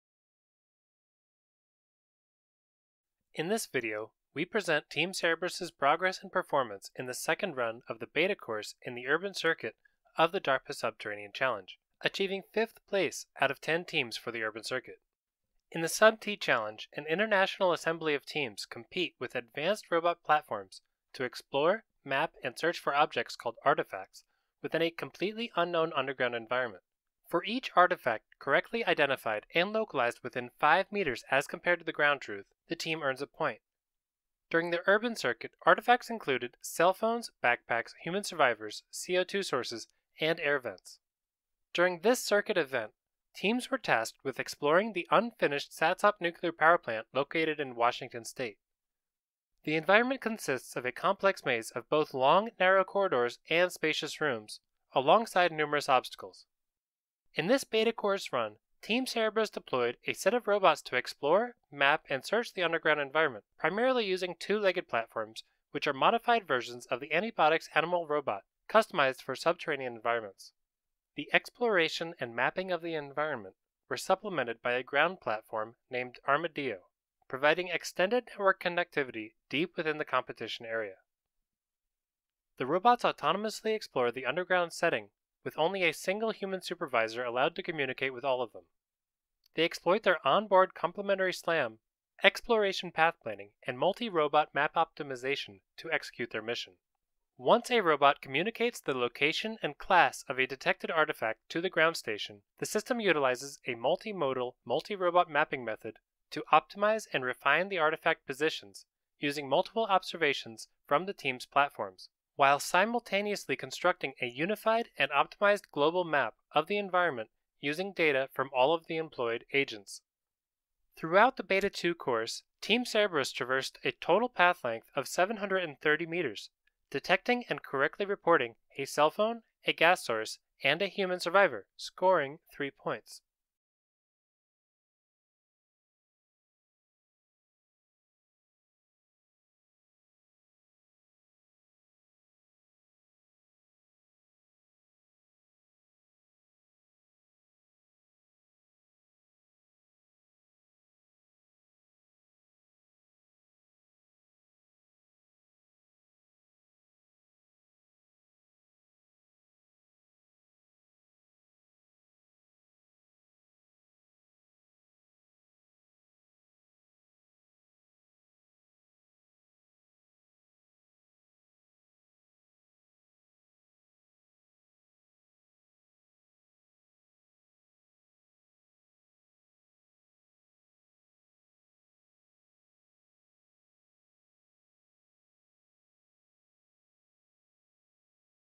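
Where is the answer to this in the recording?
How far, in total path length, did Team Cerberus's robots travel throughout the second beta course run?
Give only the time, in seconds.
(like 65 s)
125 s.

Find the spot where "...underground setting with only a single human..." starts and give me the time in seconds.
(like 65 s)
84 s.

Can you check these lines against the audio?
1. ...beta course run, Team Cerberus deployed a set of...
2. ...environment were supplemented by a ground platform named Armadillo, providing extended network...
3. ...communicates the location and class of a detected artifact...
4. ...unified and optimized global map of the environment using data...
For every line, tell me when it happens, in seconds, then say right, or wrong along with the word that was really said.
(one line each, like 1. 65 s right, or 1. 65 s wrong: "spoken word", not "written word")
1. 57 s right
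2. 72 s right
3. 98 s right
4. 114 s right.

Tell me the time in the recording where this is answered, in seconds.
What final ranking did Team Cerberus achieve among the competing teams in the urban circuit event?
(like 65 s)
12 s.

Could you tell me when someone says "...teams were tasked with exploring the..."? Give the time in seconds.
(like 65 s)
43 s.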